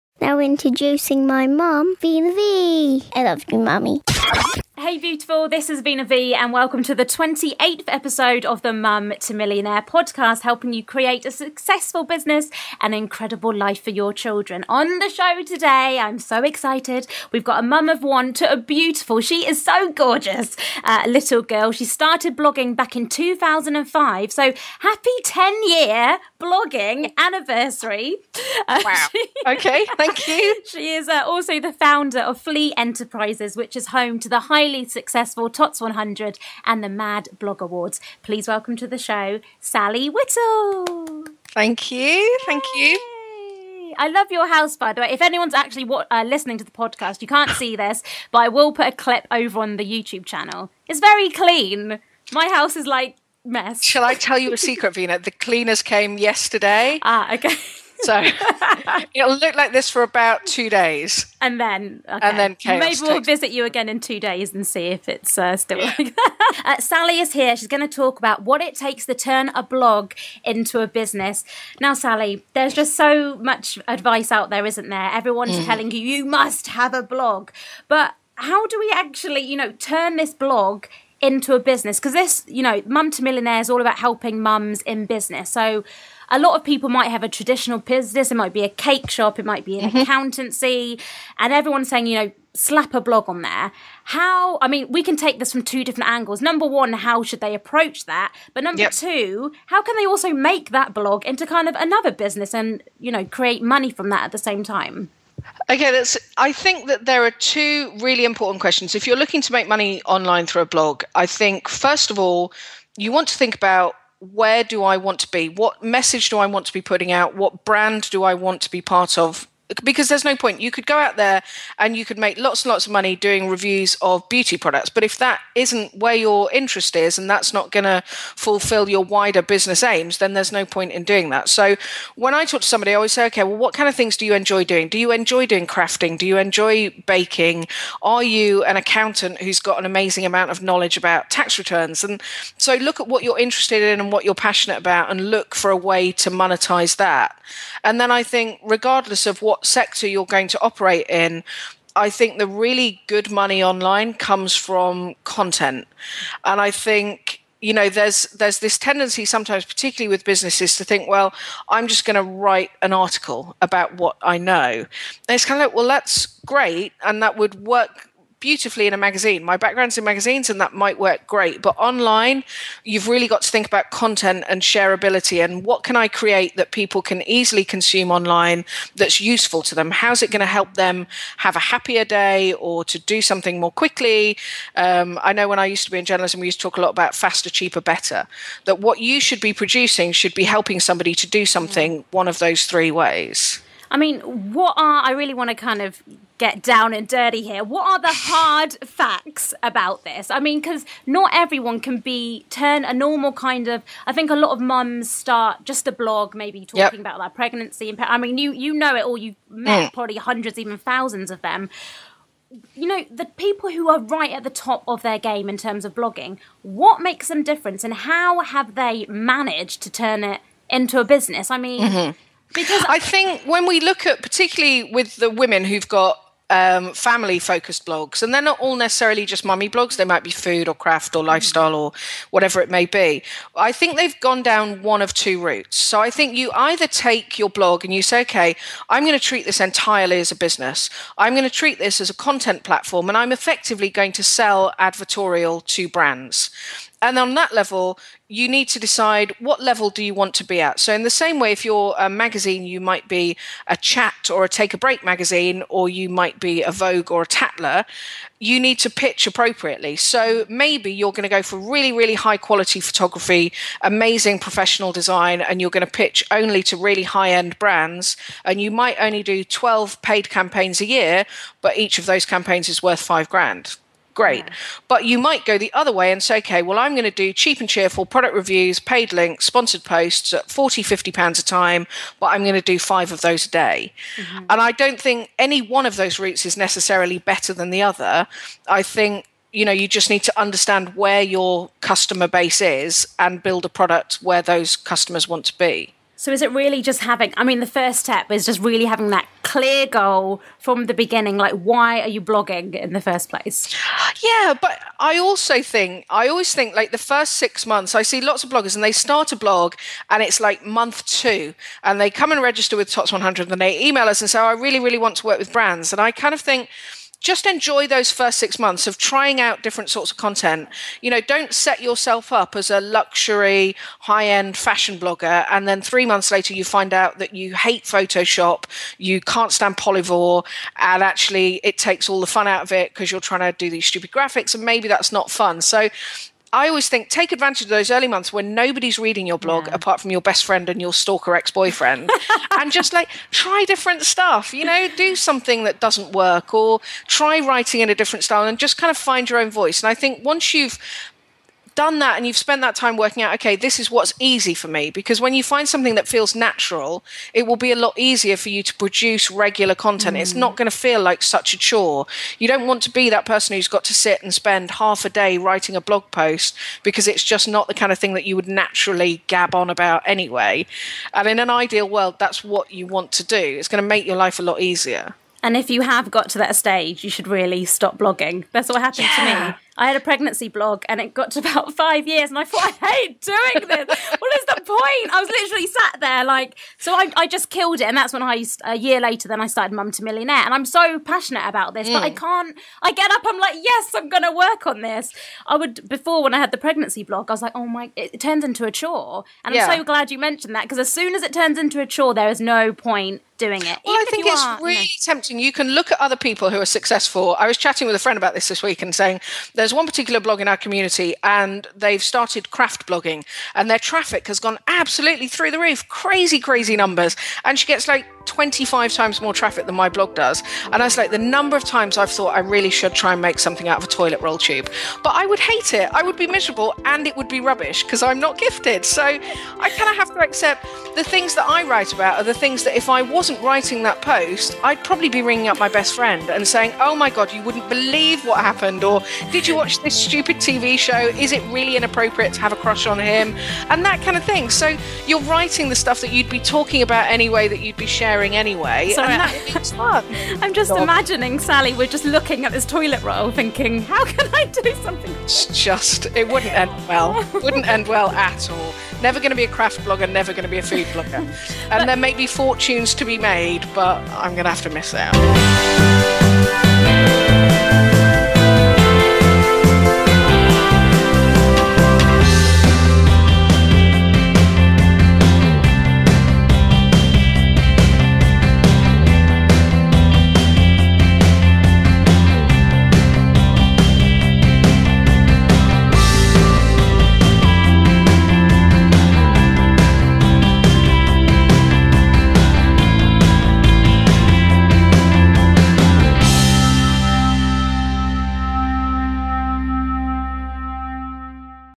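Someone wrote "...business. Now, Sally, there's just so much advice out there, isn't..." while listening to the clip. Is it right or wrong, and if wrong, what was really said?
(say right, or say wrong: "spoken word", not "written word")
right.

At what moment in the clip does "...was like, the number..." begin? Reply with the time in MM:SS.
07:00.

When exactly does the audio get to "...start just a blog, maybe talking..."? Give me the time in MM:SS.
03:25.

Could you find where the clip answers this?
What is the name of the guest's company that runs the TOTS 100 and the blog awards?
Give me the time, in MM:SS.
00:32.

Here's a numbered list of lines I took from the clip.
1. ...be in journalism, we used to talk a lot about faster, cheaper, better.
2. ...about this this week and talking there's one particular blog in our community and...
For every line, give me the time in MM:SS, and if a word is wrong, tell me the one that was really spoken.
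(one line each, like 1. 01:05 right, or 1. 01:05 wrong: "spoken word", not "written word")
1. 03:05 right
2. 06:48 wrong: "saying", not "talking".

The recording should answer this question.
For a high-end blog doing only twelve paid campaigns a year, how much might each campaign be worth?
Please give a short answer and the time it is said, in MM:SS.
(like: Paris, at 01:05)
5 grand, at 04:33.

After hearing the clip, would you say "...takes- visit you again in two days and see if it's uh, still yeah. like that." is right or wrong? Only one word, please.
right.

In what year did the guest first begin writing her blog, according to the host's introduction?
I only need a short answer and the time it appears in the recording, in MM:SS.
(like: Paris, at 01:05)
2005, at 00:23.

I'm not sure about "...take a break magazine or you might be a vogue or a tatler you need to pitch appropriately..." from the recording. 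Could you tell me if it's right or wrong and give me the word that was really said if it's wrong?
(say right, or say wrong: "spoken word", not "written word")
right.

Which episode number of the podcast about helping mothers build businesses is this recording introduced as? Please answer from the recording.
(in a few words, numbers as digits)
28th.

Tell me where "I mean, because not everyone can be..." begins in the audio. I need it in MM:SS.
03:20.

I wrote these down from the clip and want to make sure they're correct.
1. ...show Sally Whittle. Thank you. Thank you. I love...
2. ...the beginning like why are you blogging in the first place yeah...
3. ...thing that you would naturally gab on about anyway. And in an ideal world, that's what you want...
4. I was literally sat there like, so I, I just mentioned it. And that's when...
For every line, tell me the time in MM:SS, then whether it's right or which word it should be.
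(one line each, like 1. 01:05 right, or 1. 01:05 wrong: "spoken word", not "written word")
1. 00:38 right
2. 05:00 right
3. 06:07 right
4. 06:25 wrong: "killed", not "mentioned".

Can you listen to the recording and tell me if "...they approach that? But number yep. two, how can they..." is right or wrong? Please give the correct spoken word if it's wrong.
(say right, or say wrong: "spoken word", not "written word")
right.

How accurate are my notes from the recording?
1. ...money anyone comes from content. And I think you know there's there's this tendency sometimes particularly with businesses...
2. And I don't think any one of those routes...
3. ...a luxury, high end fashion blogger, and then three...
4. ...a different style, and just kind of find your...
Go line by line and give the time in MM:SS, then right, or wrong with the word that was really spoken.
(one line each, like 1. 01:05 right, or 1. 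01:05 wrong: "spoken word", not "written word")
1. 02:33 wrong: "online", not "anyone"
2. 04:44 right
3. 05:22 right
4. 05:47 right.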